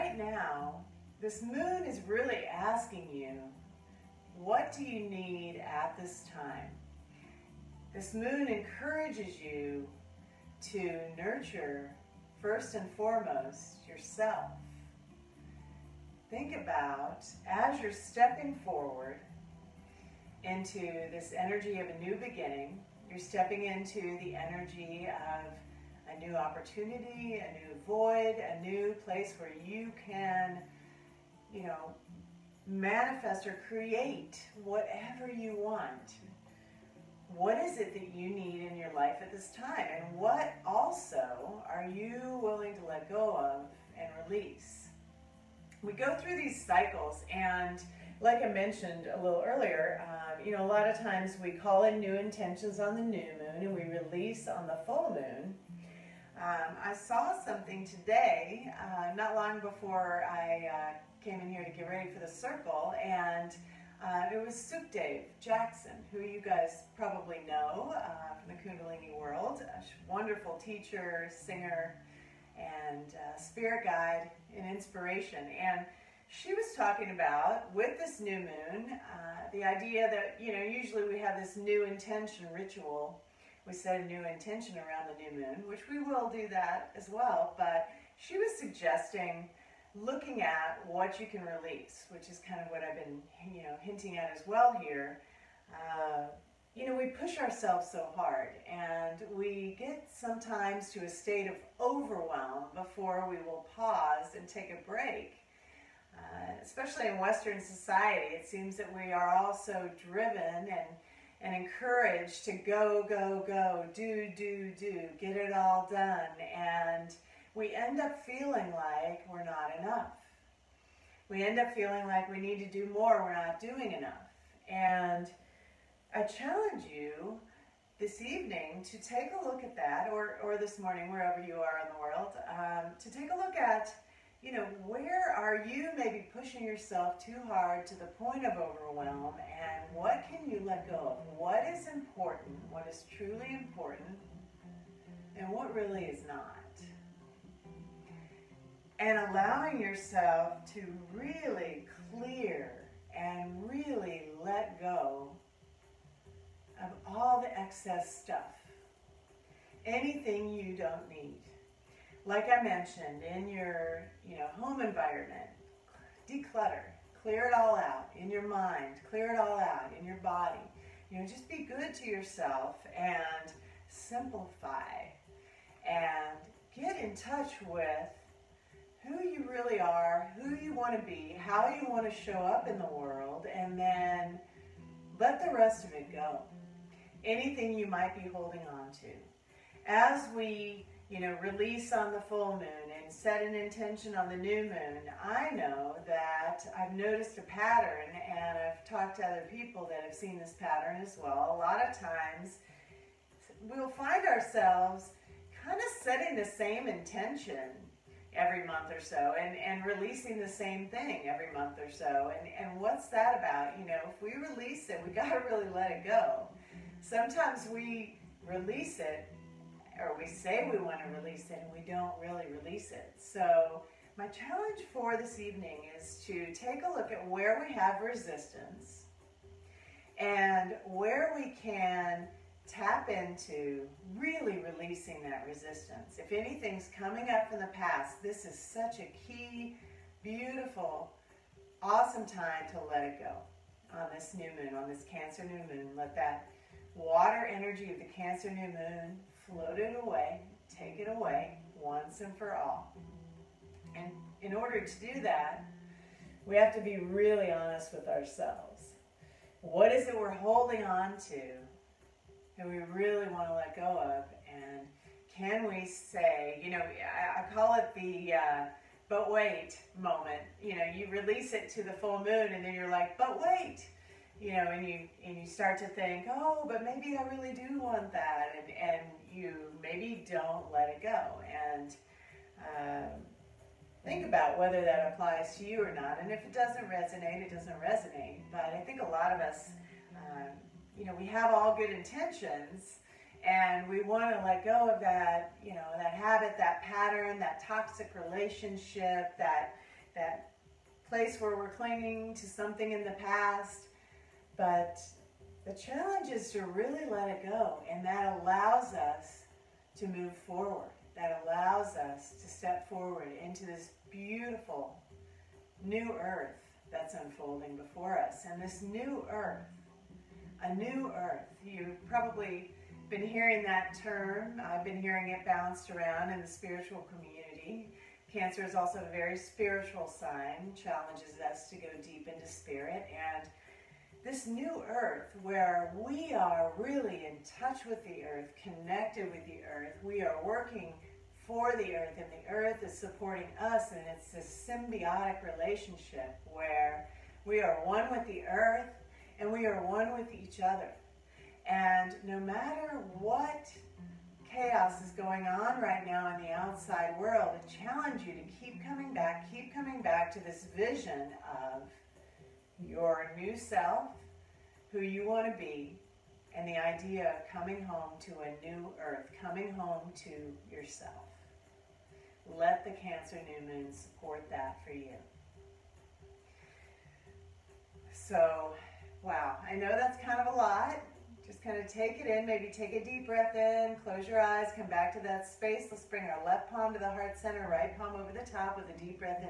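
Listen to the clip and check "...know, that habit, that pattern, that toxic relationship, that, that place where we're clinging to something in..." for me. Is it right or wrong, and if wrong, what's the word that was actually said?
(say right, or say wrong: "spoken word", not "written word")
right.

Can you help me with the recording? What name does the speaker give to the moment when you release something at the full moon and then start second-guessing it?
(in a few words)
but wait moment.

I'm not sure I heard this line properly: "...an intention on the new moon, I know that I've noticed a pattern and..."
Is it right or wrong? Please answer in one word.
right.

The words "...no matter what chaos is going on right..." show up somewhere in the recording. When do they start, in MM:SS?
05:52.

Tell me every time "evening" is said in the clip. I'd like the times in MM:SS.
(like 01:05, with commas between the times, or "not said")
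02:08, 03:45.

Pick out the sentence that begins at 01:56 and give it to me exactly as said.
And we end up feeling like we're not enough.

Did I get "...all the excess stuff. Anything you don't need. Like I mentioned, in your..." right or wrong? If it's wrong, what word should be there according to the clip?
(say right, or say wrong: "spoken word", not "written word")
right.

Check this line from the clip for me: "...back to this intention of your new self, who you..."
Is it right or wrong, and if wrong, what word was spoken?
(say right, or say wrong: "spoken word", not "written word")
wrong: "vision", not "intention".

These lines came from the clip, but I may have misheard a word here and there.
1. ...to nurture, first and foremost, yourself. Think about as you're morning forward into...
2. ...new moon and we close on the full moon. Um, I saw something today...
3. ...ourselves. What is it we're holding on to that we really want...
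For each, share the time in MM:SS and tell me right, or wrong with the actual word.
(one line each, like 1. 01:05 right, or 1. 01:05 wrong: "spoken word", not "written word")
1. 00:10 wrong: "stepping", not "morning"
2. 00:53 wrong: "release", not "close"
3. 04:18 right.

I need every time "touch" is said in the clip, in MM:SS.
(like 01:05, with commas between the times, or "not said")
02:57, 05:37.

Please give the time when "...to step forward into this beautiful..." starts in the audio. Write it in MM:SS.
05:12.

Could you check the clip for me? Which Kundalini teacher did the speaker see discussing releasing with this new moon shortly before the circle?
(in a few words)
Dave Jackson.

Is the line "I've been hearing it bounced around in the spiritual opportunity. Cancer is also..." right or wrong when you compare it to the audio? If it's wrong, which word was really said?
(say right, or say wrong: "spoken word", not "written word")
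wrong: "community", not "opportunity".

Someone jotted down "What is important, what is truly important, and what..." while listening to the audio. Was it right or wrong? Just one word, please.
right.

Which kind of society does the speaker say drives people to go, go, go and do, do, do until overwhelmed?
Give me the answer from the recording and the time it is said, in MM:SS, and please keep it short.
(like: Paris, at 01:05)
Western society, at 01:47.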